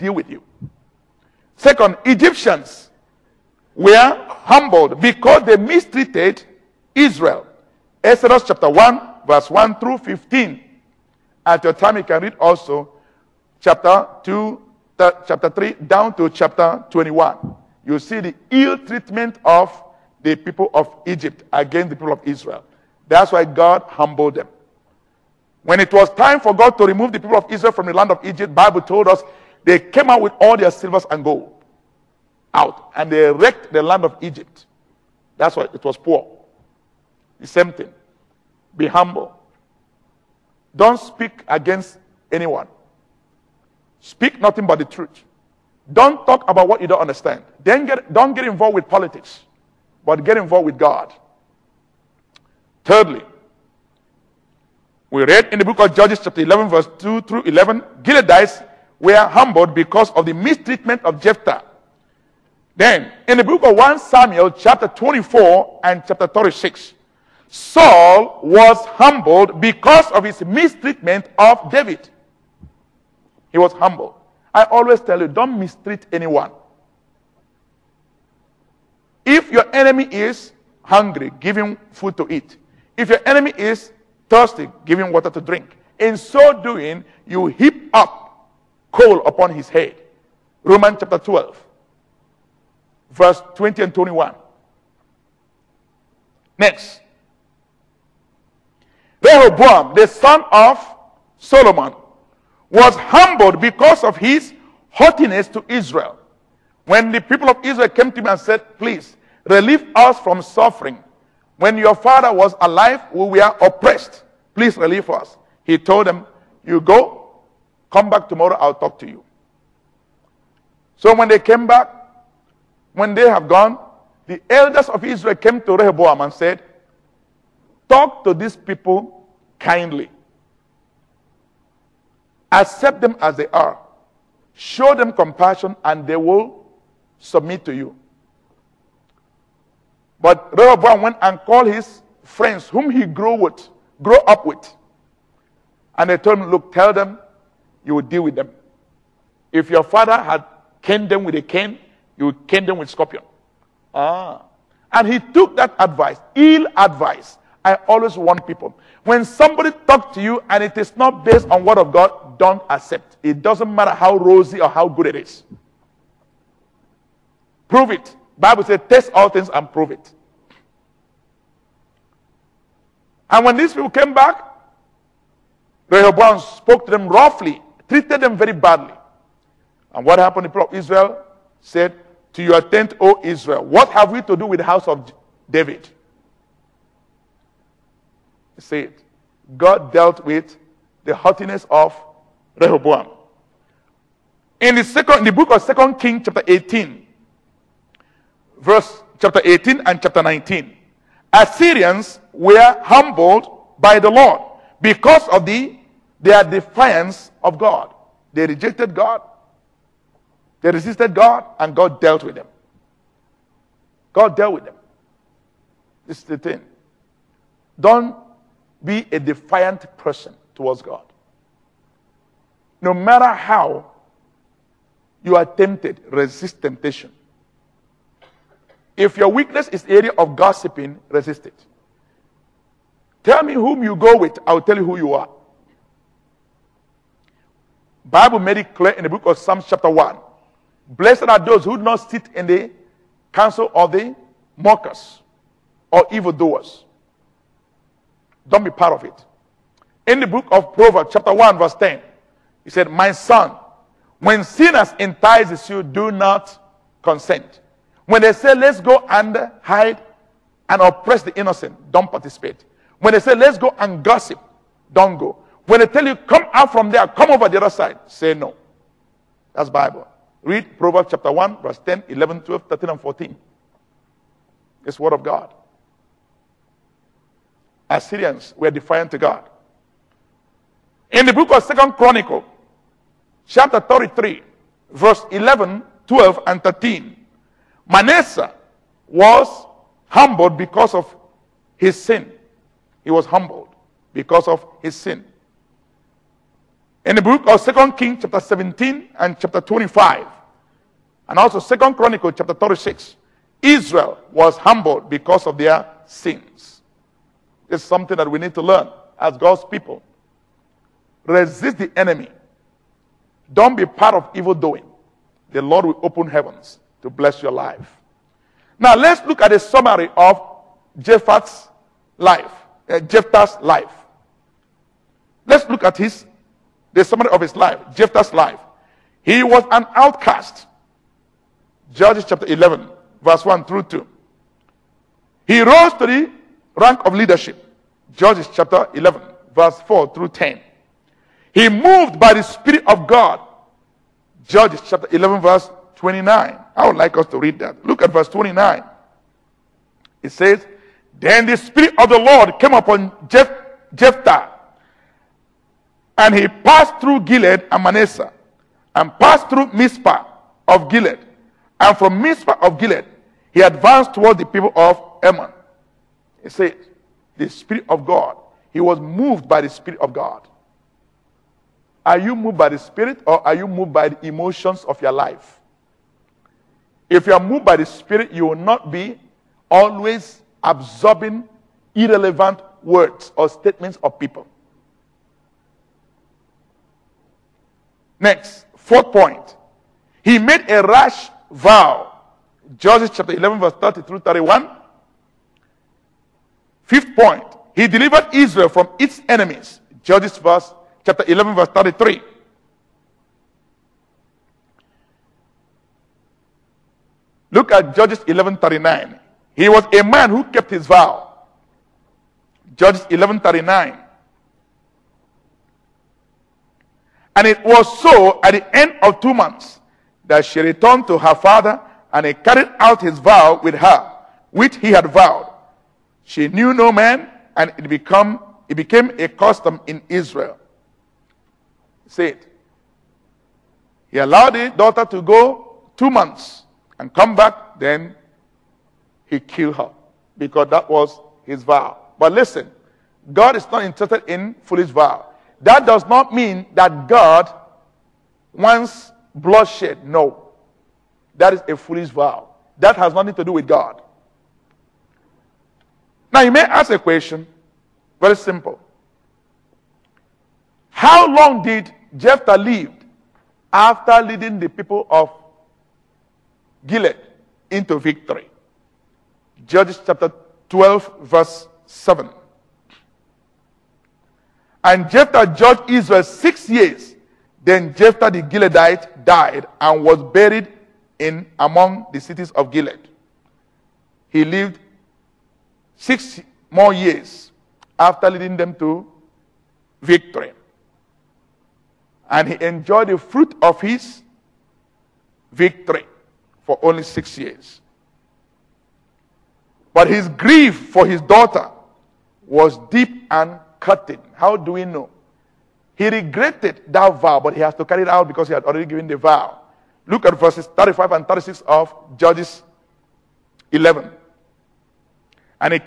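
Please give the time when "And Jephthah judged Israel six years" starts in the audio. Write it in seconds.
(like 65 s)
474 s.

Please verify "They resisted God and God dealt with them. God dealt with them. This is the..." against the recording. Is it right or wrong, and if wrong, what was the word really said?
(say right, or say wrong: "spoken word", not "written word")
right.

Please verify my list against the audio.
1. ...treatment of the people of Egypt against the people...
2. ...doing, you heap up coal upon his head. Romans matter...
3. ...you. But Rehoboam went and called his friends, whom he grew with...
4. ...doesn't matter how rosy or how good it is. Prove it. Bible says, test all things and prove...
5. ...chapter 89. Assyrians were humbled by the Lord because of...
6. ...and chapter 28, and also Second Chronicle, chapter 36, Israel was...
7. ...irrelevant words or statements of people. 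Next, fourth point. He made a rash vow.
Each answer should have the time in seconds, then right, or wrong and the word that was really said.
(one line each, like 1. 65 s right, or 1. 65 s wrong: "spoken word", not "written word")
1. 18 s right
2. 86 s wrong: "chapter", not "matter"
3. 137 s right
4. 163 s right
5. 200 s wrong: "19", not "89"
6. 299 s wrong: "25", not "28"
7. 381 s right.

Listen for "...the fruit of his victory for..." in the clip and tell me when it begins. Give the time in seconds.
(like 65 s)
493 s.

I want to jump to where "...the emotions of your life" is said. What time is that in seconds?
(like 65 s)
374 s.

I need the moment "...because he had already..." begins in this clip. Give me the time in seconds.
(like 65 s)
508 s.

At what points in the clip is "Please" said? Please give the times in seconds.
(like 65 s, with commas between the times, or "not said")
108 s, 114 s.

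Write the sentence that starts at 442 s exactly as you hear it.
But listen, God is not interested in foolish vow.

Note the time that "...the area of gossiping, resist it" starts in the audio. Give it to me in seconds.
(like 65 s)
229 s.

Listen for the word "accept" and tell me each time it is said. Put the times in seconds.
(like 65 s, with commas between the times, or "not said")
132 s, 162 s.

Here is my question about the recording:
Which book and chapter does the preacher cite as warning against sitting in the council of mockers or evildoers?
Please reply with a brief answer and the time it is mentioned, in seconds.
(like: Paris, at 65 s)
Psalms chapter 1, at 239 s.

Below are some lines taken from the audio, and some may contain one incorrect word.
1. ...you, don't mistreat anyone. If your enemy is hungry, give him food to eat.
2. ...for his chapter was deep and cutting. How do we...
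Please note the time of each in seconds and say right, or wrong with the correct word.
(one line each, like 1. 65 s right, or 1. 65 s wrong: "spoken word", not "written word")
1. 75 s right
2. 500 s wrong: "daughter", not "chapter".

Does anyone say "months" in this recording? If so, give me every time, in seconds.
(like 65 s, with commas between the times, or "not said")
419 s, 436 s.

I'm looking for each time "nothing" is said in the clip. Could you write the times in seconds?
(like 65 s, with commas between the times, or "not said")
44 s, 453 s.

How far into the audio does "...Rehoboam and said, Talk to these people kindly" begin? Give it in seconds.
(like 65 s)
125 s.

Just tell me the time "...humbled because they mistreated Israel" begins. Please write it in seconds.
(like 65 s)
4 s.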